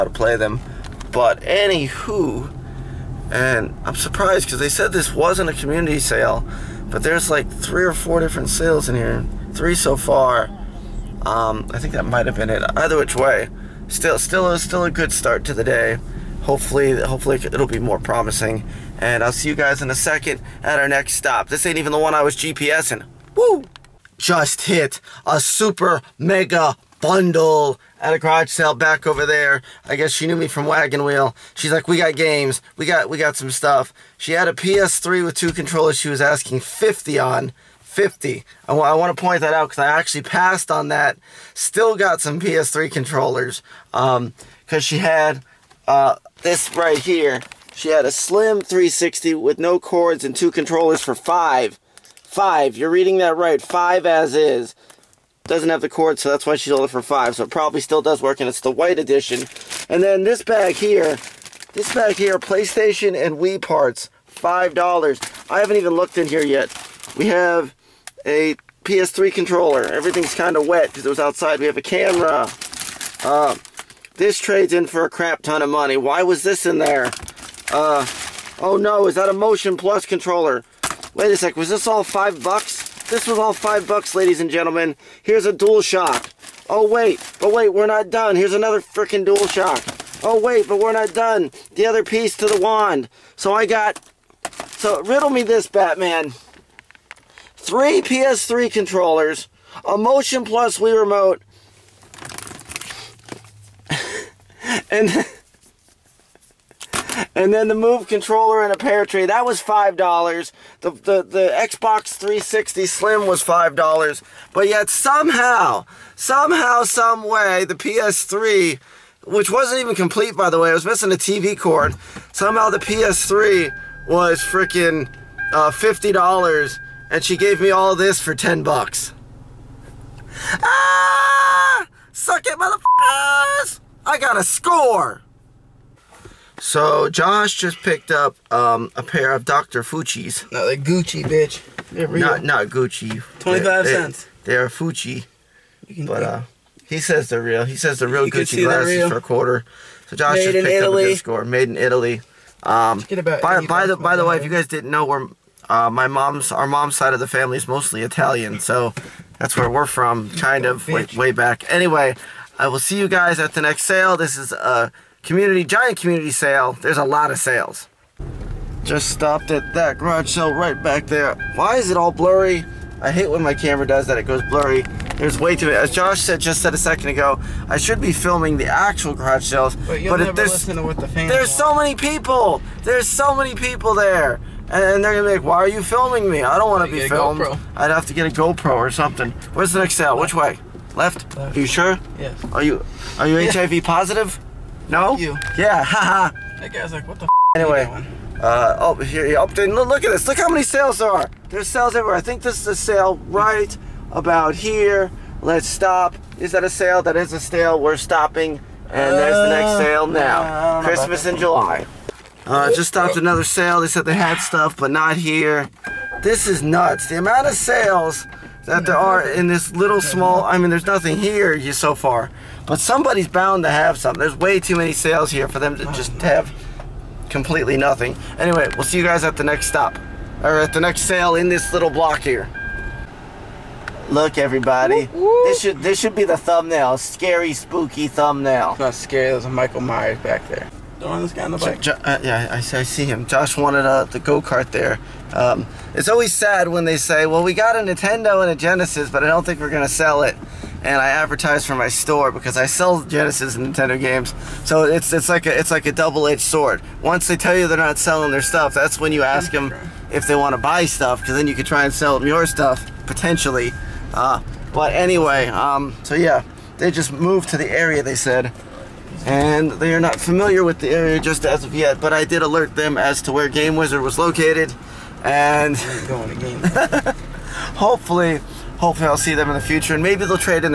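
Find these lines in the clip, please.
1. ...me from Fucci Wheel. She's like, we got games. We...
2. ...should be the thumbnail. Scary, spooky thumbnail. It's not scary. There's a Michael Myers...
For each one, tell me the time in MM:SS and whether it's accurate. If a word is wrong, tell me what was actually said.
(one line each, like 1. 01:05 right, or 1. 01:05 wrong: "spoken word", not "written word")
1. 00:30 wrong: "Wagon", not "Fucci"
2. 03:55 right.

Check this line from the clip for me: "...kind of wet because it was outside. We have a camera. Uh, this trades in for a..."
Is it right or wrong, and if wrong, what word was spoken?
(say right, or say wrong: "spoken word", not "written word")
right.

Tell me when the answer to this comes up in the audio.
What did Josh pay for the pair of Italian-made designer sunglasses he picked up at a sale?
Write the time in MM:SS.
02:23.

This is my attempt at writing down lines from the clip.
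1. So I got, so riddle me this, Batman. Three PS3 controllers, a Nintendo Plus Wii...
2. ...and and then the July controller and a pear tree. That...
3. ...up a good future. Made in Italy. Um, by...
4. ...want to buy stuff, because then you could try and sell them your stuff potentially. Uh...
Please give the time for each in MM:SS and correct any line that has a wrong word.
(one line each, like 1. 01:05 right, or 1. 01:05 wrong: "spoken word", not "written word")
1. 01:33 wrong: "Motion", not "Nintendo"
2. 01:44 wrong: "Move", not "July"
3. 02:30 wrong: "score", not "future"
4. 04:20 right.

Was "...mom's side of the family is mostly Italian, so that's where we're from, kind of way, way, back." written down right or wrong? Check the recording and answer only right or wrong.
right.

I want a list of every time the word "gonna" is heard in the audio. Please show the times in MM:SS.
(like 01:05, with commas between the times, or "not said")
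03:05, 04:09.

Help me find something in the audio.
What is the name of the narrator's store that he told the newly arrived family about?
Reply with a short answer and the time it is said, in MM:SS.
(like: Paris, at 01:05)
Game Wizard, at 04:33.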